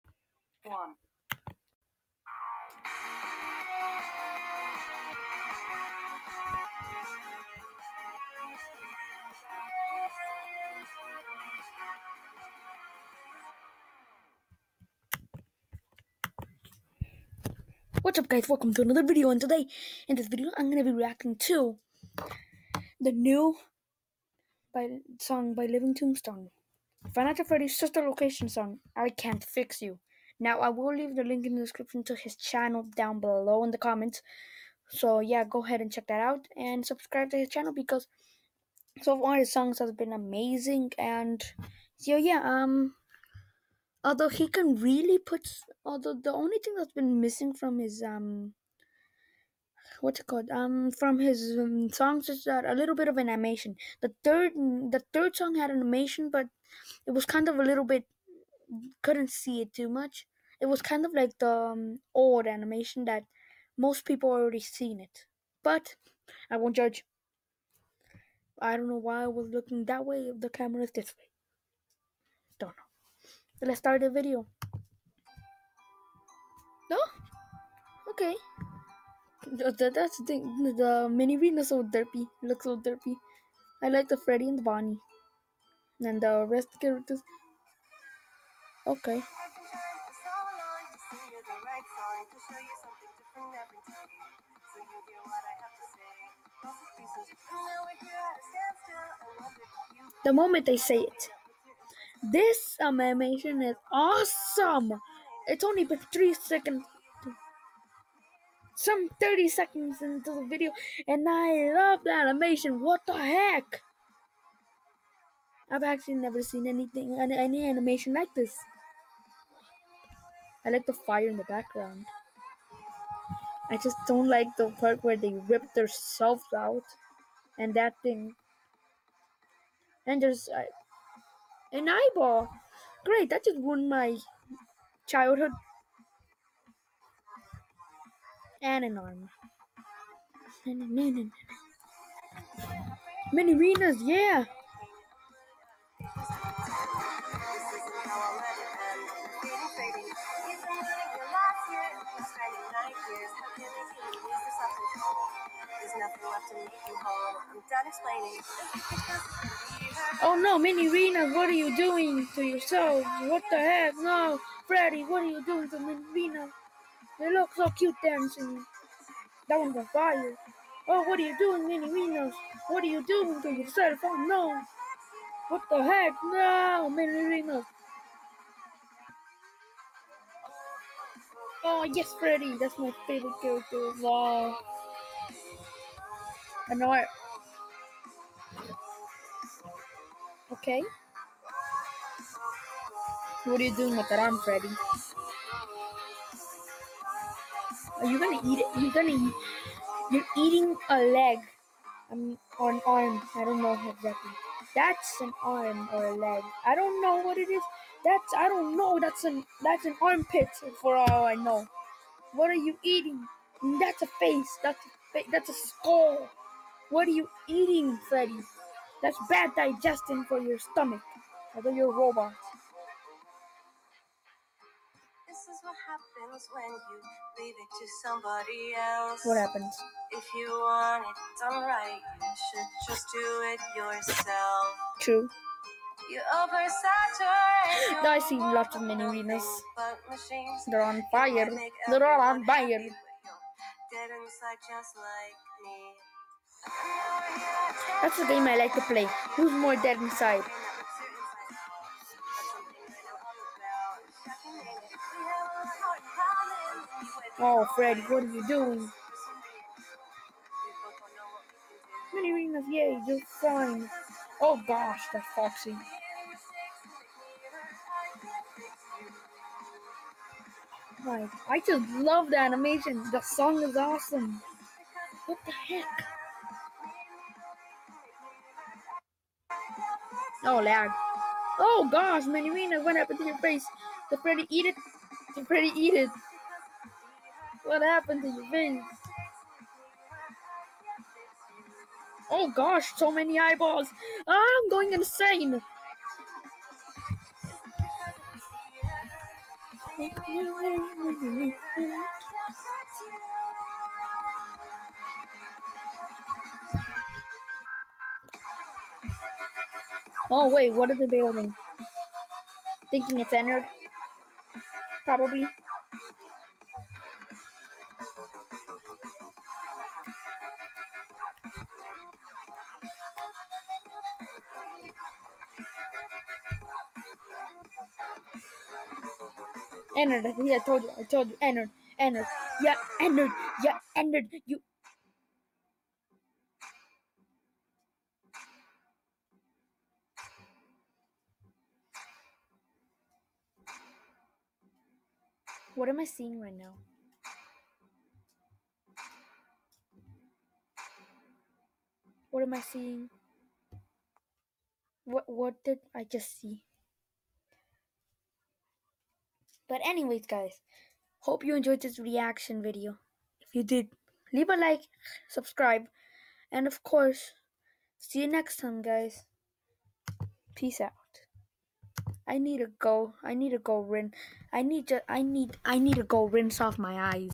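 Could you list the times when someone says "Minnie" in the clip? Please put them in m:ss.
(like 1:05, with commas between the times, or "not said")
2:45, 2:56.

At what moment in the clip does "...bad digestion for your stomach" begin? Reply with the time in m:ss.
3:39.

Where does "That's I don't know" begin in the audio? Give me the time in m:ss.
3:28.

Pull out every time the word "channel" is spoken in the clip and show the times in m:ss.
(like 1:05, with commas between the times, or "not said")
0:32, 0:37.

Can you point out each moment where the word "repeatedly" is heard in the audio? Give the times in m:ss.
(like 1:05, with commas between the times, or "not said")
not said.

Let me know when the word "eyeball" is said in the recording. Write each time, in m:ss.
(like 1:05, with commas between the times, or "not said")
2:11, 4:53.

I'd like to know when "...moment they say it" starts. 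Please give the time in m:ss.
1:40.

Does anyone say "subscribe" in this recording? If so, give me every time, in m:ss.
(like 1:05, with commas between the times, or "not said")
0:36, 6:05.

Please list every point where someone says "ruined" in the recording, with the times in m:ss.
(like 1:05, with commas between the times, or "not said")
2:13.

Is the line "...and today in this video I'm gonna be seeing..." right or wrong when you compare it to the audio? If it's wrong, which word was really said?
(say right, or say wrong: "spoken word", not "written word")
wrong: "reacting", not "seeing".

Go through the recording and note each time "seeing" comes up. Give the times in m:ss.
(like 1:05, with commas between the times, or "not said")
5:46, 5:52.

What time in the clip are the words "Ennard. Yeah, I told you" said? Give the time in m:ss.
5:29.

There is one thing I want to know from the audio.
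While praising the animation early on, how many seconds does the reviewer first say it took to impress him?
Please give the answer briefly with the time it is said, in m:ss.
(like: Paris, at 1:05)
3, at 1:46.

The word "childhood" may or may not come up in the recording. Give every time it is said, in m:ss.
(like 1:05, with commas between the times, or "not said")
2:15.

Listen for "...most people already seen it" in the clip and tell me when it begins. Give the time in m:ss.
1:03.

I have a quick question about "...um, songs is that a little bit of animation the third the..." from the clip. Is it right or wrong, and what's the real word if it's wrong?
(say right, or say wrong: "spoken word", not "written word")
right.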